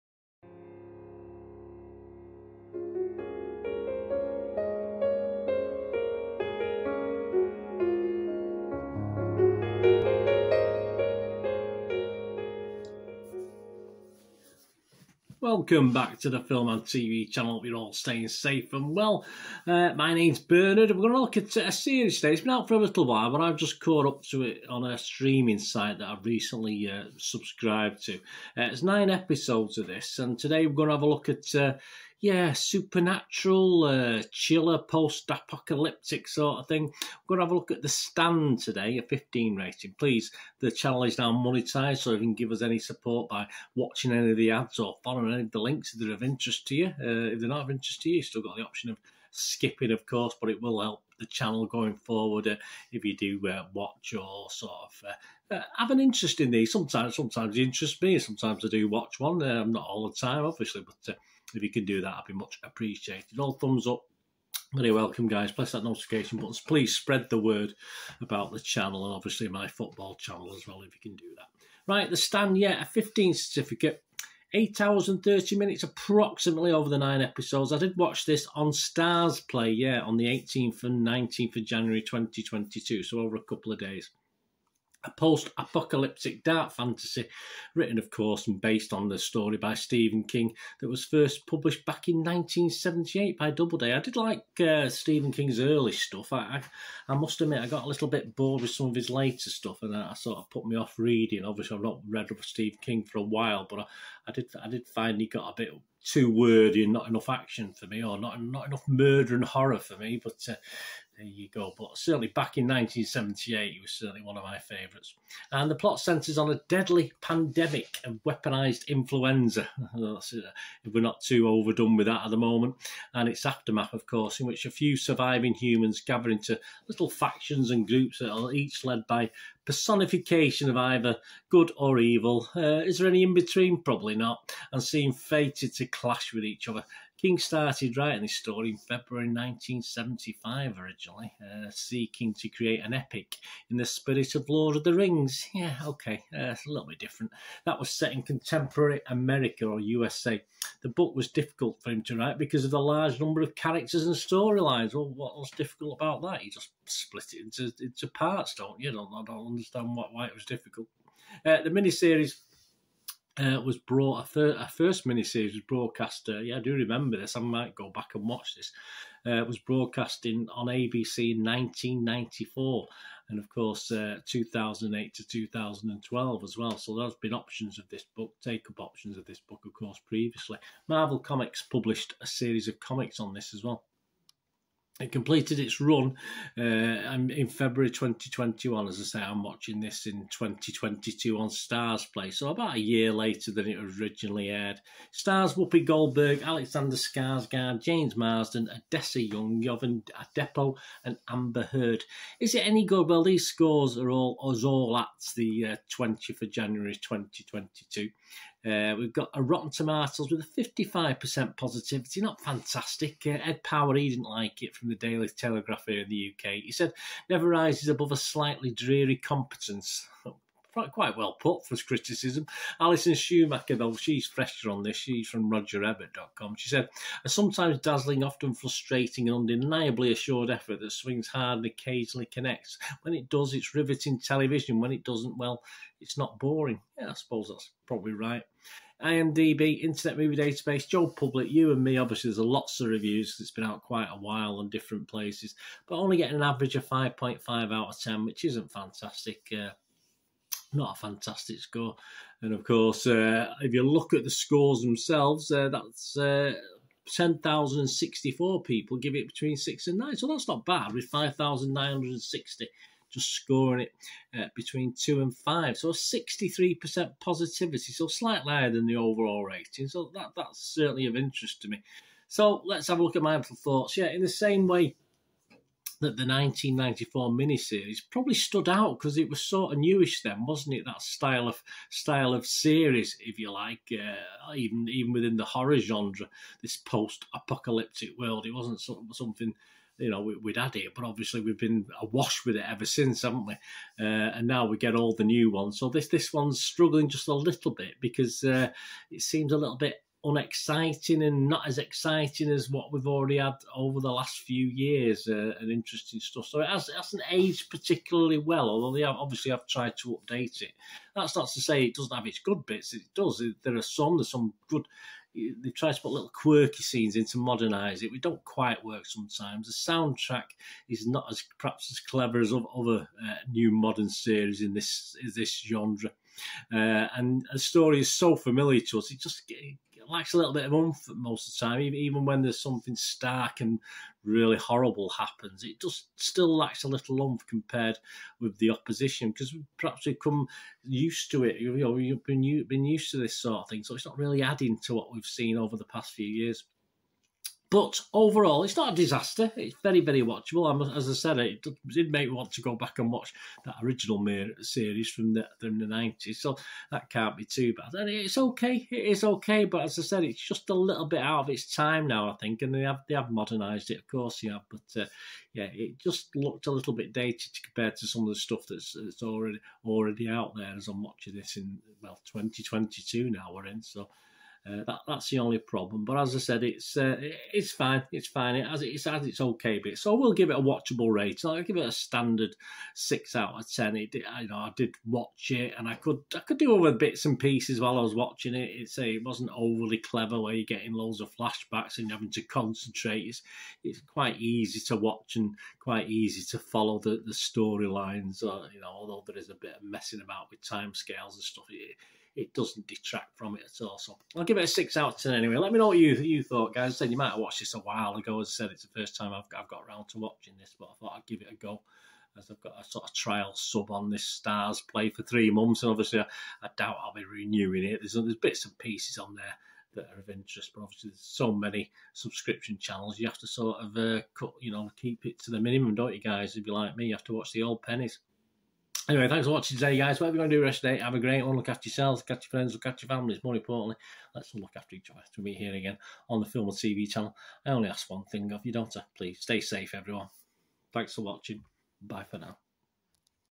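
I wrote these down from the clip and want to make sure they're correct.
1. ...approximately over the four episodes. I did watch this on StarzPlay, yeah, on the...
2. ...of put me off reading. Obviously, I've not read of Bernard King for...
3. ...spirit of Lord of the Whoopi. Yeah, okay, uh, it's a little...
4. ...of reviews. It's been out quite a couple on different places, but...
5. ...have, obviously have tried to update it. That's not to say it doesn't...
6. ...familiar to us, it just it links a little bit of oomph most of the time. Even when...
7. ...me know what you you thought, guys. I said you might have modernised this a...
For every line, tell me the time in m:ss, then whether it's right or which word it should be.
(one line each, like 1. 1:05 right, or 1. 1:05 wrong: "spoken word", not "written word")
1. 1:15 wrong: "nine", not "four"
2. 1:40 wrong: "Stephen", not "Bernard"
3. 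2:23 wrong: "Rings", not "Whoopi"
4. 4:02 wrong: "while", not "couple"
5. 5:09 right
6. 5:28 wrong: "lacks", not "links"
7. 6:45 wrong: "watched", not "modernised".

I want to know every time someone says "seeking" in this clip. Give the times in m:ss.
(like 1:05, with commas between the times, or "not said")
2:21.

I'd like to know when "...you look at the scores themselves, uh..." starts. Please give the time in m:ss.
4:13.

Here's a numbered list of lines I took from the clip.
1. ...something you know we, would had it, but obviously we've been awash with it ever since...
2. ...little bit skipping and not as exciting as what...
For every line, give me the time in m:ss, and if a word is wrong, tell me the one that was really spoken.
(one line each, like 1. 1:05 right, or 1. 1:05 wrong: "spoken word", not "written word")
1. 4:49 right
2. 4:59 wrong: "unexciting", not "skipping".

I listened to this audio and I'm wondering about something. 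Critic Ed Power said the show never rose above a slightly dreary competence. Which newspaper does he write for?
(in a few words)
Daily Telegraph.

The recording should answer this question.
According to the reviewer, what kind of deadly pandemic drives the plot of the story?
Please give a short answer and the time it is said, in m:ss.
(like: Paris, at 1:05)
Weaponised influenza, at 1:58.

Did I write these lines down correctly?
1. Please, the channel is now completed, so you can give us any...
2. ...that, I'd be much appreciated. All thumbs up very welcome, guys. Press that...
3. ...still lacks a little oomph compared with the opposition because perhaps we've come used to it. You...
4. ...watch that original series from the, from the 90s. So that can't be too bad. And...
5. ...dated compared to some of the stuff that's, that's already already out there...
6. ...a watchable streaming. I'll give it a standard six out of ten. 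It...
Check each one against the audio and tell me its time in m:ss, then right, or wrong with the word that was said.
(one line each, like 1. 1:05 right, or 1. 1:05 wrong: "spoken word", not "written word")
1. 0:39 wrong: "monetized", not "completed"
2. 1:02 right
3. 5:36 right
4. 5:53 right
5. 6:07 right
6. 6:20 wrong: "rating", not "streaming".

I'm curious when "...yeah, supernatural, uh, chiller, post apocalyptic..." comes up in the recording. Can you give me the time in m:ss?
0:32.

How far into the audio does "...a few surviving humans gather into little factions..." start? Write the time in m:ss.
2:04.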